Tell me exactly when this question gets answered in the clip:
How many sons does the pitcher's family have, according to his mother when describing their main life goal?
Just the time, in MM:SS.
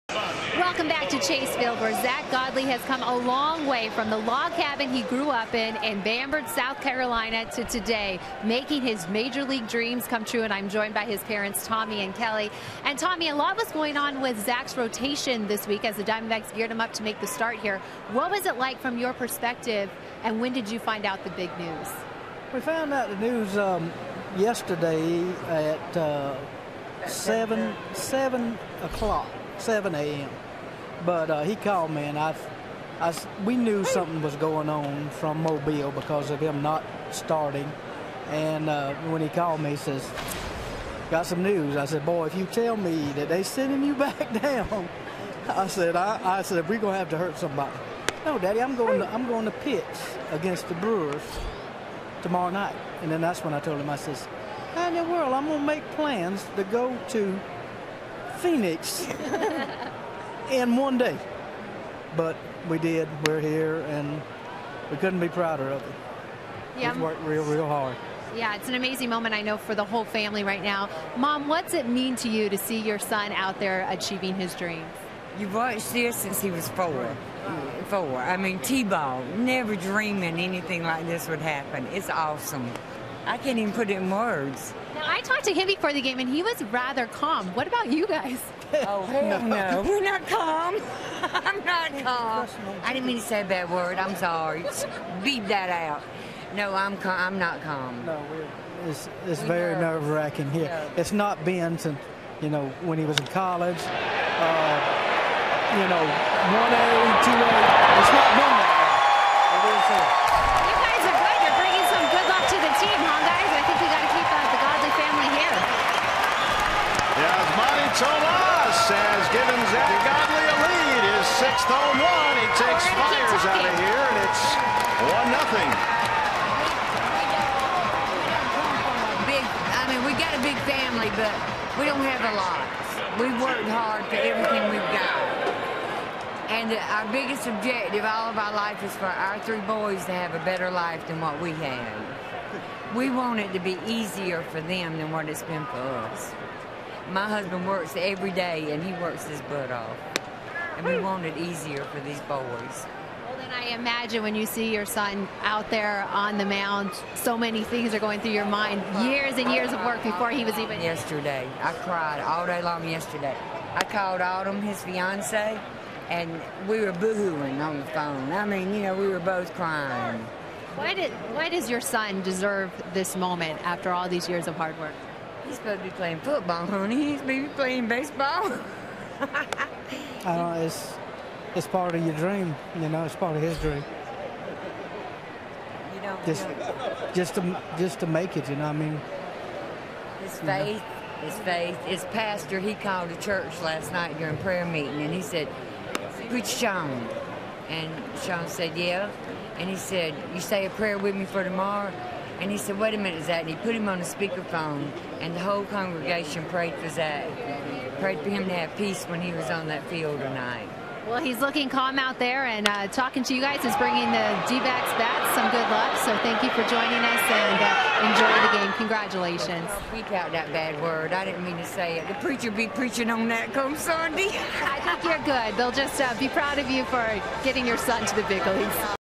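02:19.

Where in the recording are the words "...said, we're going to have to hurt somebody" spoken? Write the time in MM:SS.
00:46.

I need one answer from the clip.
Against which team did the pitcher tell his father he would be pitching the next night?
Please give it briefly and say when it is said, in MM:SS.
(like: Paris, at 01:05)
Brewers, at 00:50.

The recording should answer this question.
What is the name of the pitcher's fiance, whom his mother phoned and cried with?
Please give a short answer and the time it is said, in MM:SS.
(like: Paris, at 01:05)
Autumn, at 02:44.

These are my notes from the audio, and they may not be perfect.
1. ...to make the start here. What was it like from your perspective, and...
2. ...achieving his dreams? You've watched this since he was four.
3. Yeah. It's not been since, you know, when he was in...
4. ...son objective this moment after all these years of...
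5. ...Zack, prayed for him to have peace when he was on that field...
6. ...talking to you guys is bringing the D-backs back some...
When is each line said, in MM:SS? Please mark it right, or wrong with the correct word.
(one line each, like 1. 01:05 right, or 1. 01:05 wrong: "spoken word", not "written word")
1. 00:16 right
2. 01:13 right
3. 01:40 right
4. 02:51 wrong: "deserve", not "objective"
5. 03:26 right
6. 03:32 right.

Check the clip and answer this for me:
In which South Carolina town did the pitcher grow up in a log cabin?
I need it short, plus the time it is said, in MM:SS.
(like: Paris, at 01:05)
Bamberg, at 00:05.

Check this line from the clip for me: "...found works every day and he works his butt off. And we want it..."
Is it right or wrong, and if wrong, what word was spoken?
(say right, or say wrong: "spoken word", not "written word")
wrong: "husband", not "found".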